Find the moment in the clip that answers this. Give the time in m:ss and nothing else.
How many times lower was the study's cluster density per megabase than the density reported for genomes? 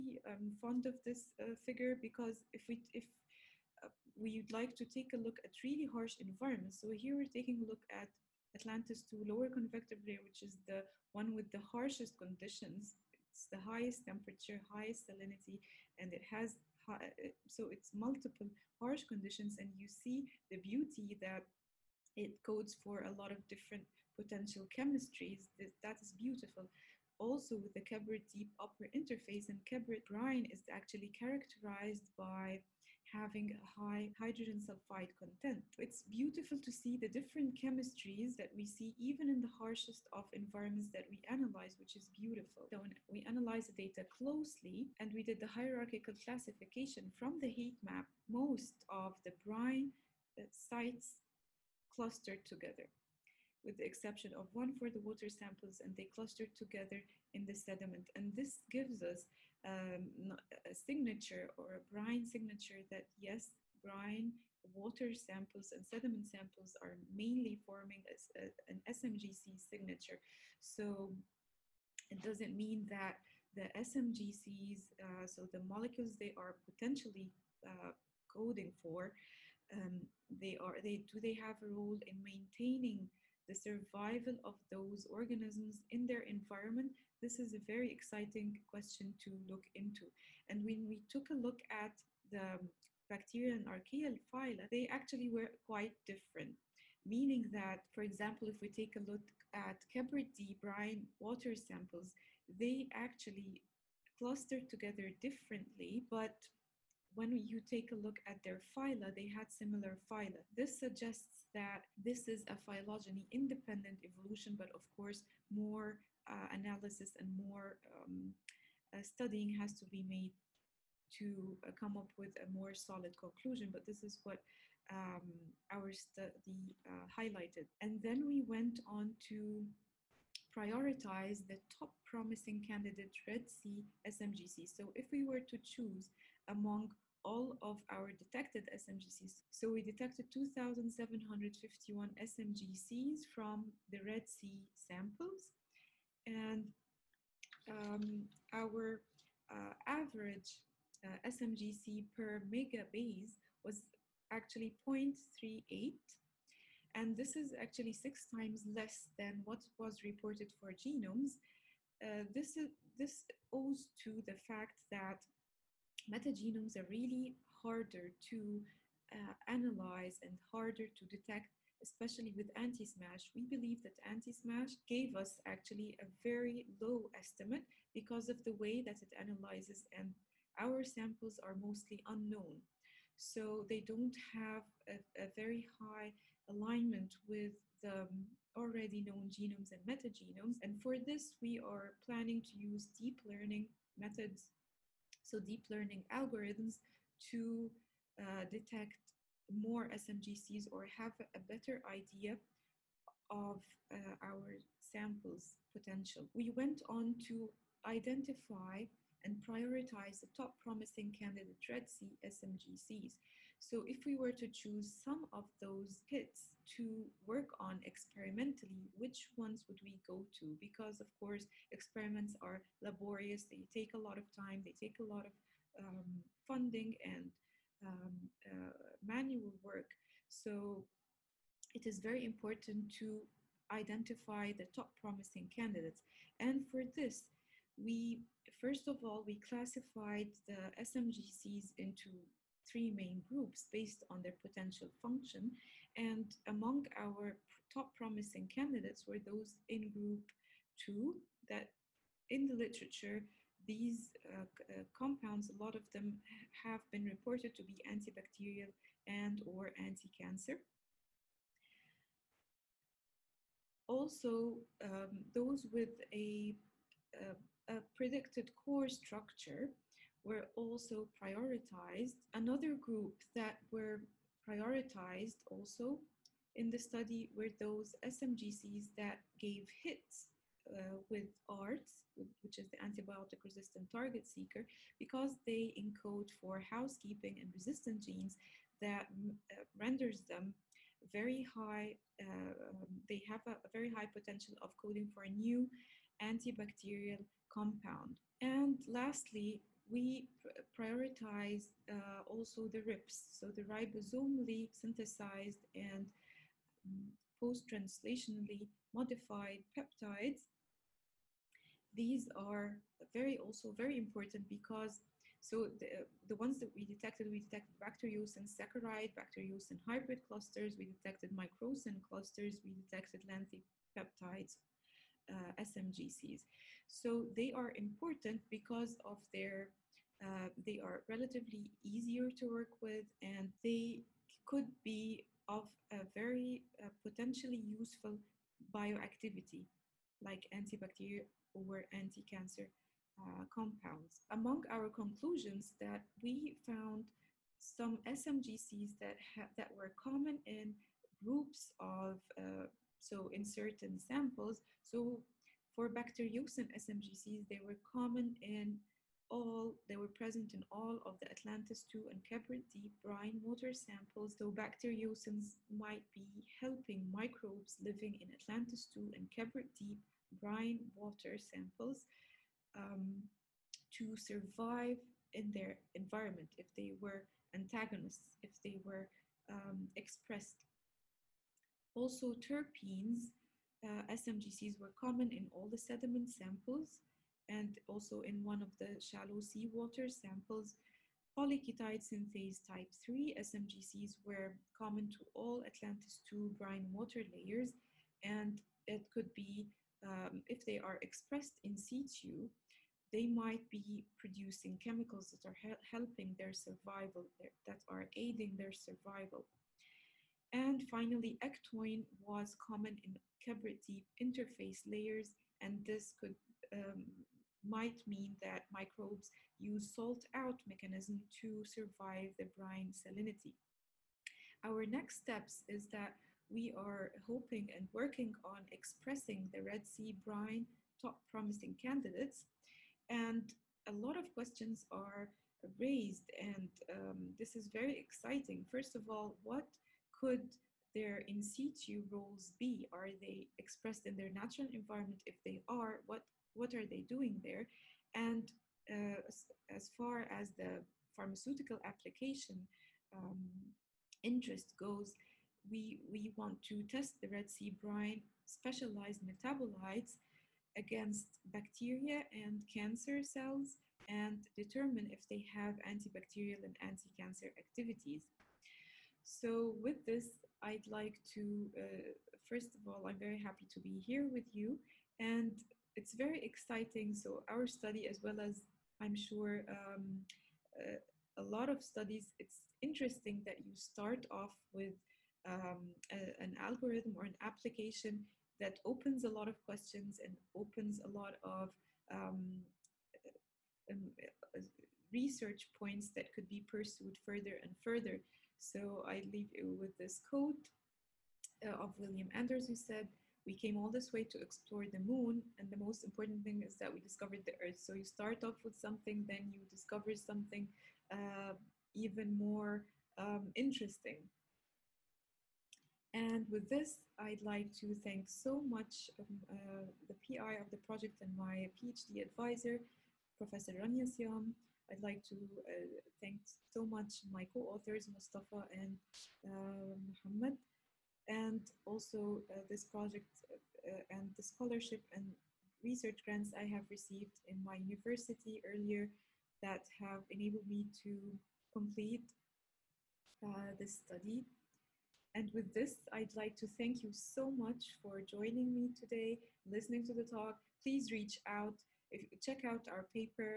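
2:37.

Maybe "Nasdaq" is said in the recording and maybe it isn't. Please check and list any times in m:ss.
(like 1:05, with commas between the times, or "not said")
not said.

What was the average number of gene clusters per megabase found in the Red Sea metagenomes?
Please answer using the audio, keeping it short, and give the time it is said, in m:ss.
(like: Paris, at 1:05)
0.38, at 2:34.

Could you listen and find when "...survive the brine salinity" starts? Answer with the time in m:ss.
7:01.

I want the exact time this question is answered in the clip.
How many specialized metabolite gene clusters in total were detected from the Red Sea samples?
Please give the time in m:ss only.
2:20.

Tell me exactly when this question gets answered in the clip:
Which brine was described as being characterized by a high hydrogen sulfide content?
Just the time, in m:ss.
0:29.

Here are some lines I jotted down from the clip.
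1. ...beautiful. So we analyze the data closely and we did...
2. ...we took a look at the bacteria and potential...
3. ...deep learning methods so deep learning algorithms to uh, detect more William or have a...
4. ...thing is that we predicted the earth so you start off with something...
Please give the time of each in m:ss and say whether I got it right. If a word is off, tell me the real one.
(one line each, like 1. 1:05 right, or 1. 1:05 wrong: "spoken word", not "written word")
1. 0:42 right
2. 1:30 wrong: "archaeal", not "potential"
3. 3:12 wrong: "SMGCs", not "William"
4. 8:26 wrong: "discovered", not "predicted".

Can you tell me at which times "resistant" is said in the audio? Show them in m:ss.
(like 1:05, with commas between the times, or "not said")
4:43, 4:47.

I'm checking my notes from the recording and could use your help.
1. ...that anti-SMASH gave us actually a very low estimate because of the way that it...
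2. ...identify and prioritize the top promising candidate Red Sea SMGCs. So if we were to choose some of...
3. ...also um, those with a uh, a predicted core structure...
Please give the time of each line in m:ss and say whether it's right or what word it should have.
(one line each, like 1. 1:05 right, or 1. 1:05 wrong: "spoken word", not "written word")
1. 2:53 right
2. 3:27 right
3. 4:23 right.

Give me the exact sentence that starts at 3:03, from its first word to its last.
So they don't have a, a very high alignment with the um, already known genomes and metagenomes.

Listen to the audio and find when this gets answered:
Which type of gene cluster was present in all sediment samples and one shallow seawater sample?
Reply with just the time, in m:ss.
6:22.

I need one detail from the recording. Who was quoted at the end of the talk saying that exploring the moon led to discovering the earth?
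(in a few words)
William Anders.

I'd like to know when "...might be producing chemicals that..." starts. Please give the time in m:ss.
6:43.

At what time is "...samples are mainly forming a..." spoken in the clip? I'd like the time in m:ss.
1:06.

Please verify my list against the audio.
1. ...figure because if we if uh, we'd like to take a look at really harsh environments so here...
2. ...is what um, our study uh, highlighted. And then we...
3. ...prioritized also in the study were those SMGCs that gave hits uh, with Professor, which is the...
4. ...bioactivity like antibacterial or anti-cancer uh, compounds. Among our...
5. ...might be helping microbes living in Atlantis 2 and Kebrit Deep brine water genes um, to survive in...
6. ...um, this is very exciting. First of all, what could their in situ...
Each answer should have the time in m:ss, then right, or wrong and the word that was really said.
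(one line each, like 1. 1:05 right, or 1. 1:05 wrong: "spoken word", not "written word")
1. 0:01 right
2. 2:04 right
3. 4:34 wrong: "ARTS", not "Professor"
4. 5:38 right
5. 6:05 wrong: "samples", not "genes"
6. 7:16 right.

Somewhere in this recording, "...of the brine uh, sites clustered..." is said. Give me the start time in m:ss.
0:48.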